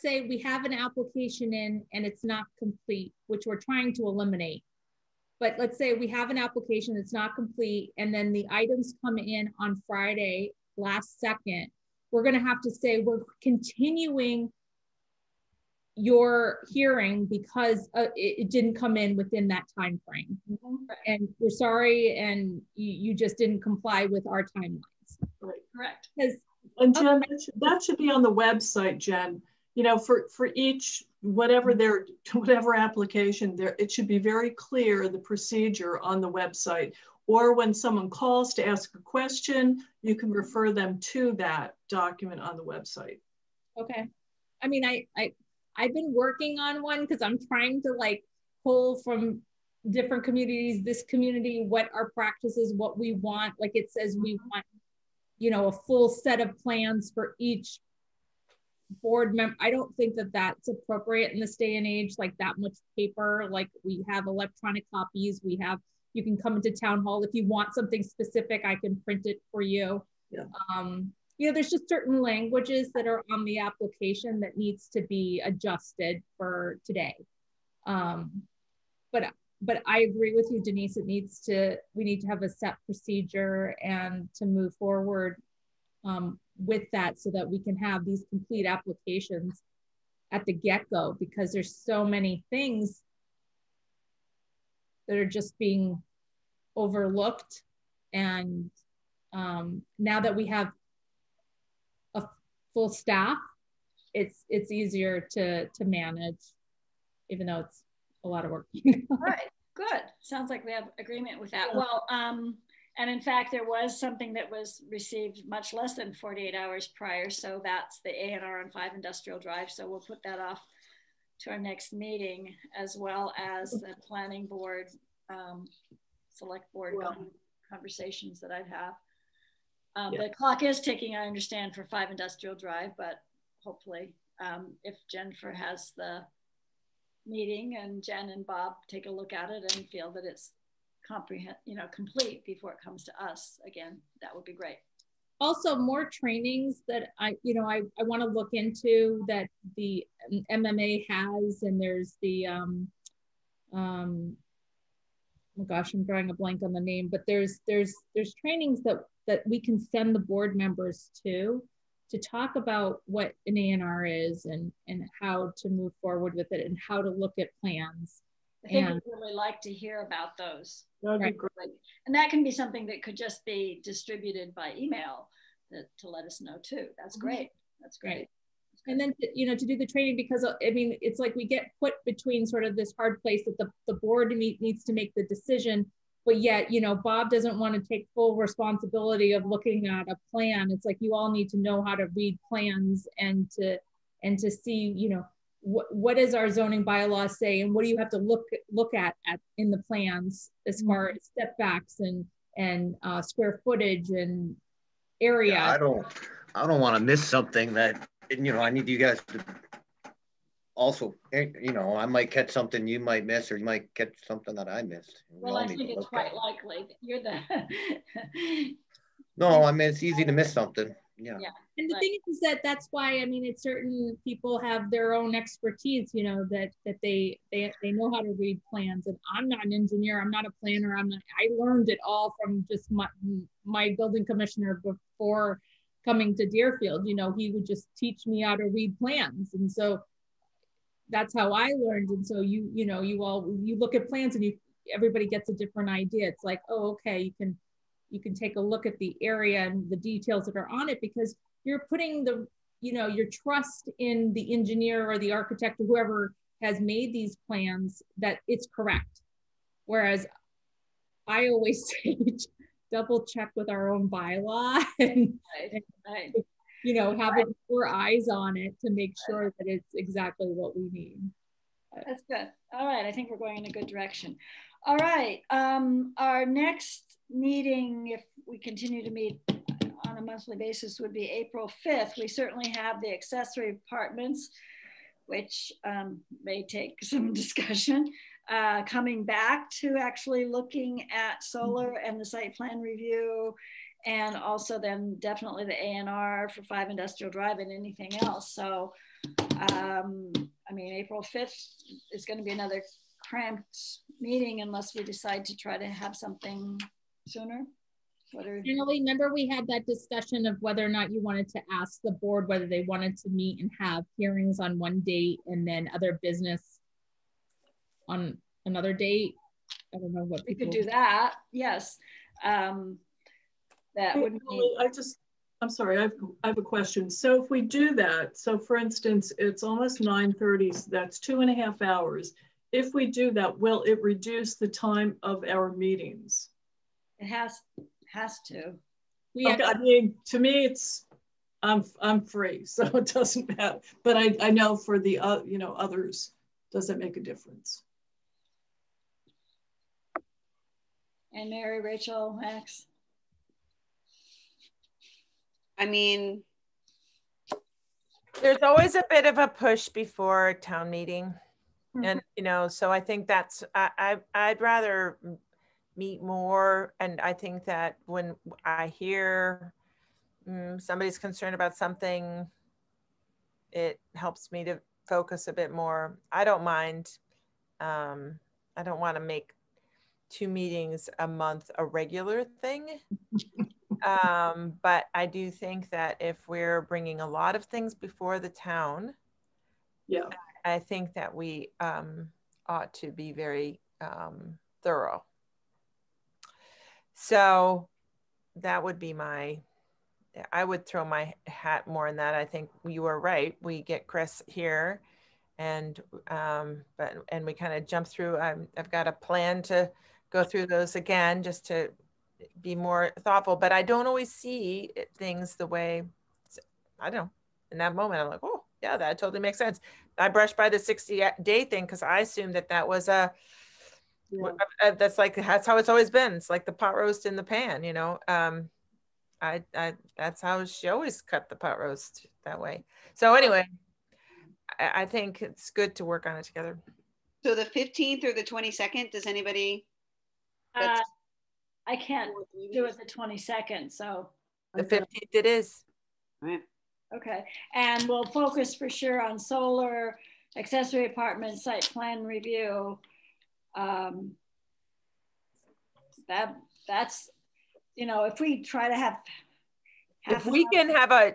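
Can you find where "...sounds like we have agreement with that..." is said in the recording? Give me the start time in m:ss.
1:50.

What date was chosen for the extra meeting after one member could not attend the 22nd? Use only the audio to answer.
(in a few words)
15th.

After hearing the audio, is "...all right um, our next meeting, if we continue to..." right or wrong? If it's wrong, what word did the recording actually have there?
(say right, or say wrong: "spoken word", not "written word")
right.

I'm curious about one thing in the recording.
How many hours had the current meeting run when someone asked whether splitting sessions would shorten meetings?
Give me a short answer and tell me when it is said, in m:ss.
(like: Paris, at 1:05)
2 and a half, at 5:31.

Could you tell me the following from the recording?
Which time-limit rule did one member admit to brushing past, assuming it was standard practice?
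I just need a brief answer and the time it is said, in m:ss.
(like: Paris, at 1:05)
60 day, at 7:00.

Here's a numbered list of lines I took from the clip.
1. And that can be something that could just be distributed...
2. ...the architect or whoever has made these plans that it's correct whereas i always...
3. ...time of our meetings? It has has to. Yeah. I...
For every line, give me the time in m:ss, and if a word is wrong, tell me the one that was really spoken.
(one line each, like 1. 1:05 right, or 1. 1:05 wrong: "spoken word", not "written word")
1. 2:52 right
2. 4:15 right
3. 5:34 right.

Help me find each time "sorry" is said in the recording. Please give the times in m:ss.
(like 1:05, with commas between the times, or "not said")
0:21, 5:25.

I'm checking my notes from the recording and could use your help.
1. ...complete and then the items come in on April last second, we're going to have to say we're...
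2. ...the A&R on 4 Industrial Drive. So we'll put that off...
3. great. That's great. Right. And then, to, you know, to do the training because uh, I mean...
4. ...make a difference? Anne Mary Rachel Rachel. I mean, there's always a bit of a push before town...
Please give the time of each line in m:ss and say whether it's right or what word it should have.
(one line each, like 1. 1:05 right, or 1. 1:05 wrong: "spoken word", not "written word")
1. 0:07 wrong: "Friday", not "April"
2. 1:58 wrong: "5", not "4"
3. 2:57 right
4. 5:46 wrong: "Max", not "Rachel".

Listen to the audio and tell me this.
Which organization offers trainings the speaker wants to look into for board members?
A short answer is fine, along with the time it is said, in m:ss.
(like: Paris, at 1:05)
MMA, at 2:30.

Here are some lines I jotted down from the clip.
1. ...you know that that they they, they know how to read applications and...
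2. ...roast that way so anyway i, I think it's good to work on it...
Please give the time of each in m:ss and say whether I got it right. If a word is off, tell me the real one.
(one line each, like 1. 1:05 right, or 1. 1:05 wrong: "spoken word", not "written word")
1. 3:46 wrong: "plans", not "applications"
2. 7:11 right.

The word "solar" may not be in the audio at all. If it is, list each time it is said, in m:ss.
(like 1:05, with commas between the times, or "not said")
4:51, 7:29.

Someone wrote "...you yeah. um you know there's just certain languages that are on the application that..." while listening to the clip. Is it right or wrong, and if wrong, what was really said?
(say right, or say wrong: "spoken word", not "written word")
right.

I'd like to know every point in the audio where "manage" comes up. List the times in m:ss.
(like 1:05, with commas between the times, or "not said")
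1:45.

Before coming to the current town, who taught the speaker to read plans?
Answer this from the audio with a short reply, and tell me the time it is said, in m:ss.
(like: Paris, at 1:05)
building commissioner, at 3:53.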